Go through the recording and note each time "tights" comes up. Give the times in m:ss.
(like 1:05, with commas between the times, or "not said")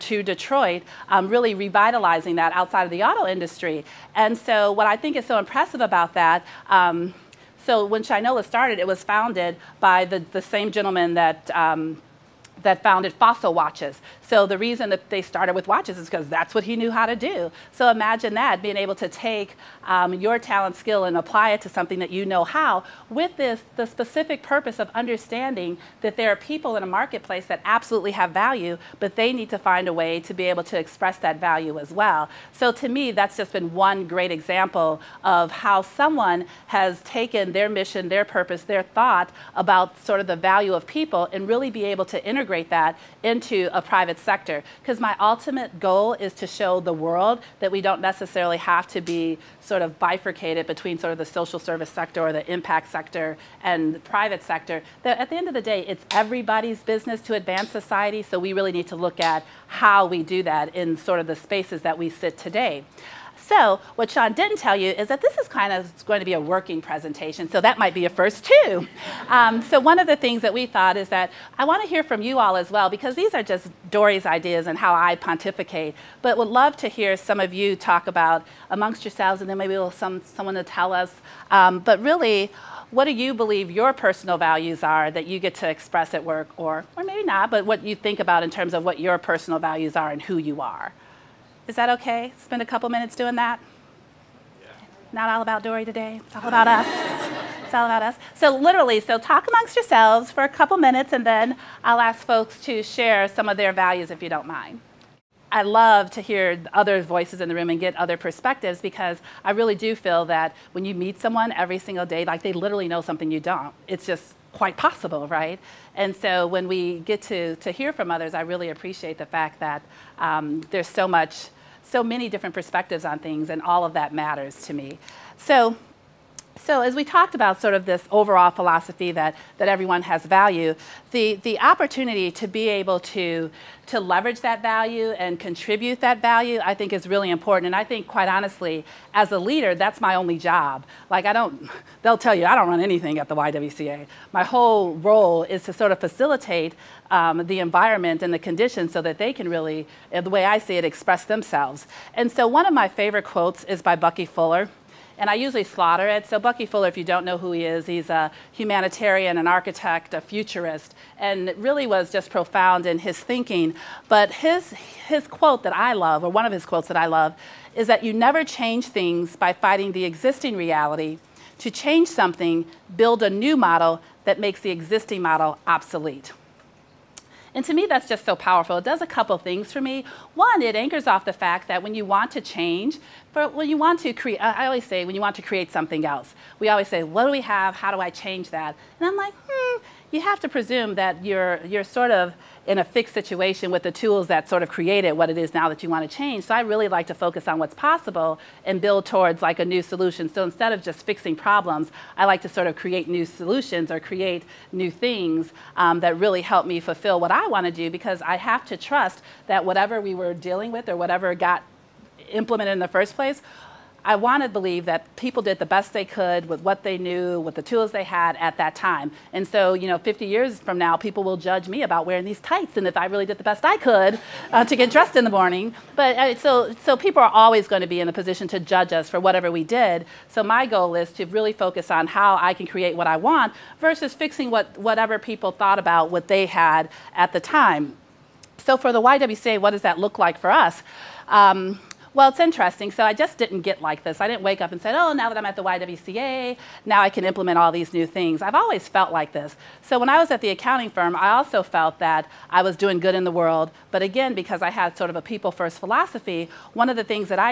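3:42.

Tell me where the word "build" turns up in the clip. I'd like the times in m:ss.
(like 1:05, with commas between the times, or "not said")
2:52, 3:18.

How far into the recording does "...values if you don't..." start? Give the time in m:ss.
1:43.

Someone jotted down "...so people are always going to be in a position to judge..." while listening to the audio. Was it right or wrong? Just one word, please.
right.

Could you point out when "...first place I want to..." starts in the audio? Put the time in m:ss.
3:32.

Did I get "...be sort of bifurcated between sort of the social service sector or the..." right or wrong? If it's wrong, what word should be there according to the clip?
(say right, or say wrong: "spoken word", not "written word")
right.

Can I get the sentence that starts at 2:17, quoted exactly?
And I think quite honestly, as a leader, that's my only job.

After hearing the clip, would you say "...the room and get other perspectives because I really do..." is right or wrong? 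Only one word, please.
right.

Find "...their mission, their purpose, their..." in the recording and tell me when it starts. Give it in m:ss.
0:37.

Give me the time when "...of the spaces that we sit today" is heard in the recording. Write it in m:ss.
1:01.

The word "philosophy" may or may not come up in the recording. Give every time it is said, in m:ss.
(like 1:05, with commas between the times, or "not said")
2:08, 4:15.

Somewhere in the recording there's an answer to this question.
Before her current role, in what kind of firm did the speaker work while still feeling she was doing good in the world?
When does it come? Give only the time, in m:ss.
4:10.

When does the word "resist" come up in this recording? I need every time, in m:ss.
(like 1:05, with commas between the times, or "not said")
not said.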